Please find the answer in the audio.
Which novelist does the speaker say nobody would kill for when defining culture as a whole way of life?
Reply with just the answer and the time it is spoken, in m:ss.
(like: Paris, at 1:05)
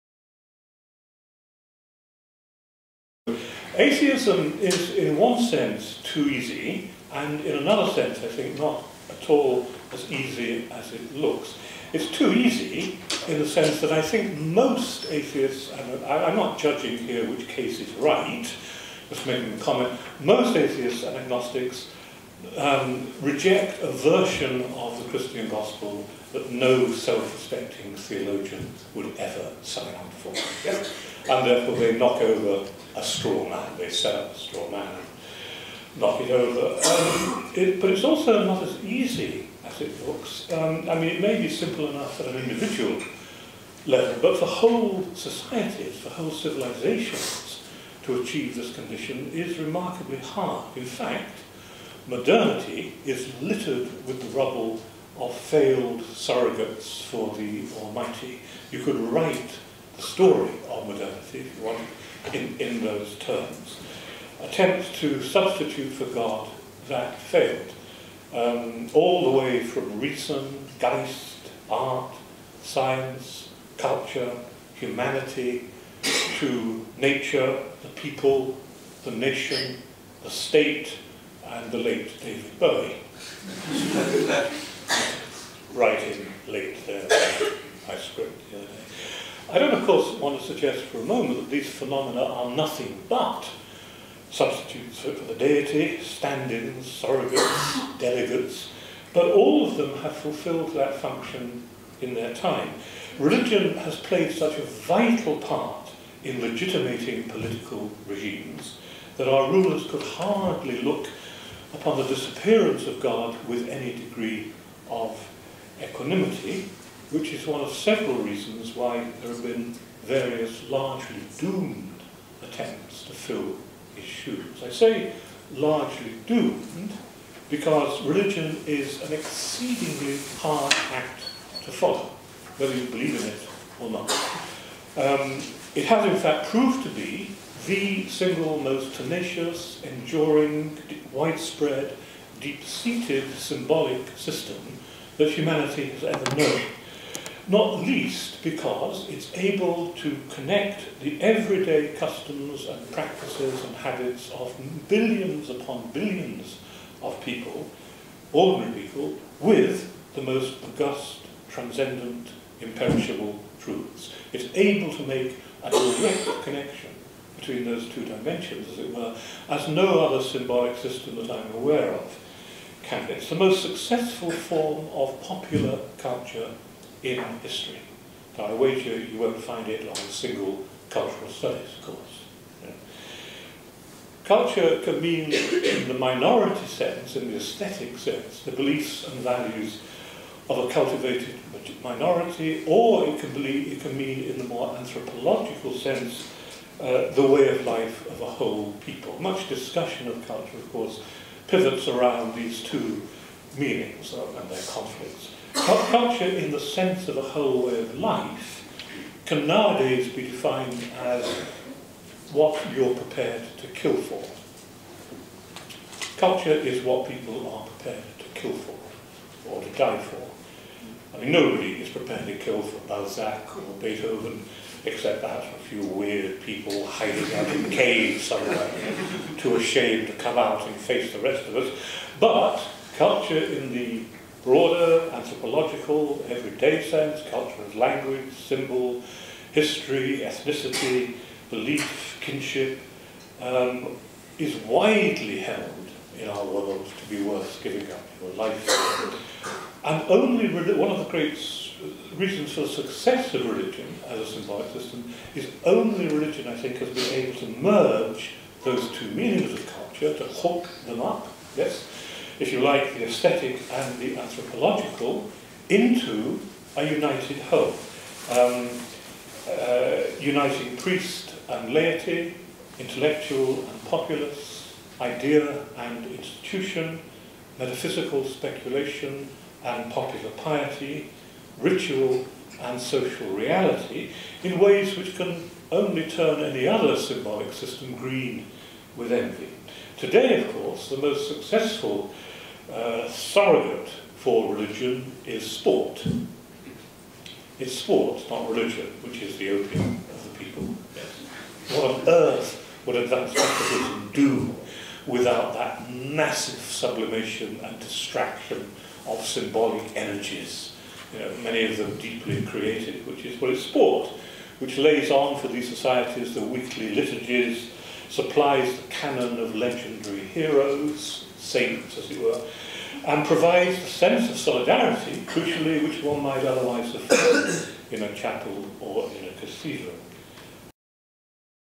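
Balzac, at 3:42.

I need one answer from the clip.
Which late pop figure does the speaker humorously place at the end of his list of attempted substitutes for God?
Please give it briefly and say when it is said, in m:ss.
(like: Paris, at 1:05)
David Bowie, at 1:22.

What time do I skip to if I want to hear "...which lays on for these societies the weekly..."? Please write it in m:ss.
5:14.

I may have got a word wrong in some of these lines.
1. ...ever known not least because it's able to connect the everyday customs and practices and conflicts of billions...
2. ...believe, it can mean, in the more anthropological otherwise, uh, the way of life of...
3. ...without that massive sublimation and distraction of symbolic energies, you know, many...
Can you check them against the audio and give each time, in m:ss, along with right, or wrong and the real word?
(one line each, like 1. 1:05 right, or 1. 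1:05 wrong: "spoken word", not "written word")
1. 2:26 wrong: "habits", not "conflicts"
2. 3:13 wrong: "sense", not "otherwise"
3. 5:05 right.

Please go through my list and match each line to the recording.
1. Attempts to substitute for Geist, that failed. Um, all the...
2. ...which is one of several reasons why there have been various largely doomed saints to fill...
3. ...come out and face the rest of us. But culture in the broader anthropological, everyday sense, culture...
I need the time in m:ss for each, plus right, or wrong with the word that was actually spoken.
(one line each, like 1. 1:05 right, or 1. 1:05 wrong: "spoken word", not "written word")
1. 1:04 wrong: "God", not "Geist"
2. 1:57 wrong: "attempts", not "saints"
3. 3:50 right.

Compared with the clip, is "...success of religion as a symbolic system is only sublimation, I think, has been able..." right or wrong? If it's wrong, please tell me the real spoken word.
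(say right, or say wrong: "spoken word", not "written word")
wrong: "religion", not "sublimation".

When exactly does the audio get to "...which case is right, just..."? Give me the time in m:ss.
0:17.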